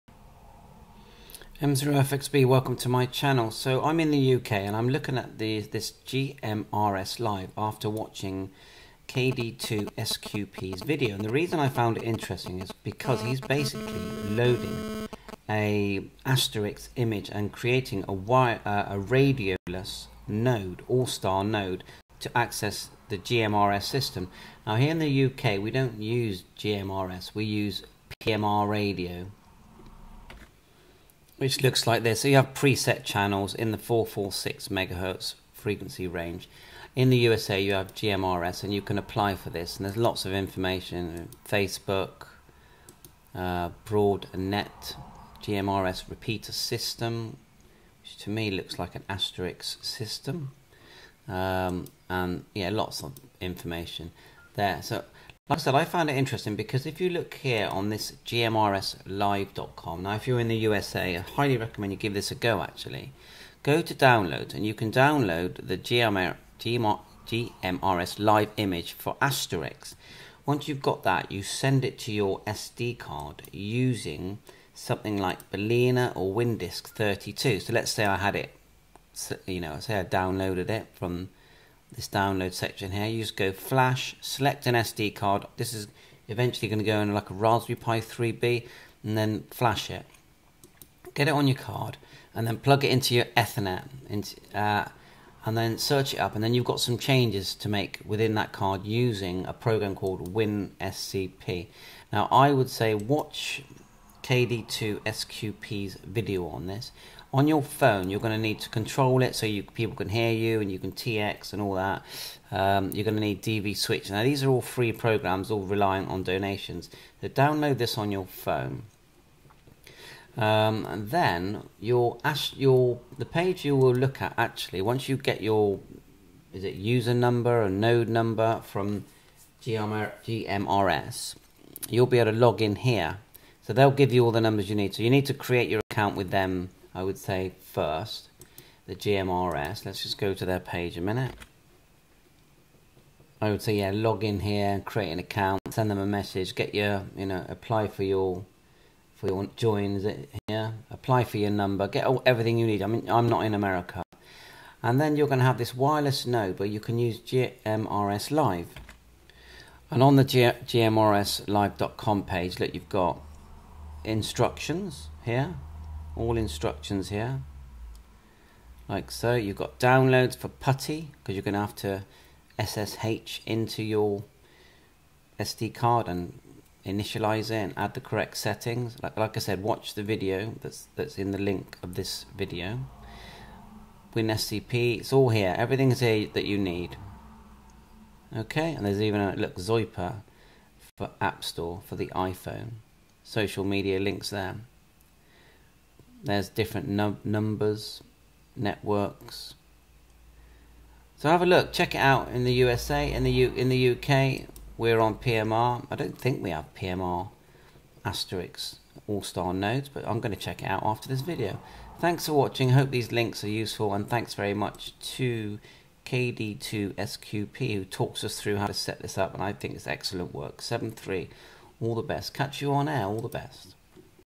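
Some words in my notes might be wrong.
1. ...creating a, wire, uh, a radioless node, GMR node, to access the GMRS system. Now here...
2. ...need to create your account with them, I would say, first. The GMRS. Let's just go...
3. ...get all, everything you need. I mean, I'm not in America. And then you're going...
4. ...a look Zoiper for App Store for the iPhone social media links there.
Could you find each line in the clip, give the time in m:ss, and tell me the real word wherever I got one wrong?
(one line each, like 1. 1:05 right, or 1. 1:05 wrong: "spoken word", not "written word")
1. 0:17 wrong: "AllStar", not "GMR"
2. 2:15 right
3. 2:31 right
4. 3:09 right.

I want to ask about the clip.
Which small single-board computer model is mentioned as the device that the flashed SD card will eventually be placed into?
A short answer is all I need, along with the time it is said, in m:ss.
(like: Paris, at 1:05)
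Raspberry Pi 3B, at 1:27.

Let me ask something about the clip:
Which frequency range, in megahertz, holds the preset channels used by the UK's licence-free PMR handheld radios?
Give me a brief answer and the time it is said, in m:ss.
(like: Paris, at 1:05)
446 megahertz, at 0:33.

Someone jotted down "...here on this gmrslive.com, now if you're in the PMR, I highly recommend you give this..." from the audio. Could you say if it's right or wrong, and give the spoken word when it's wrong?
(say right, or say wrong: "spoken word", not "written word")
wrong: "USA", not "PMR".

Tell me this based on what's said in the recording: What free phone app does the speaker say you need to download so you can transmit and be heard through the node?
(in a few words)
DV Switch.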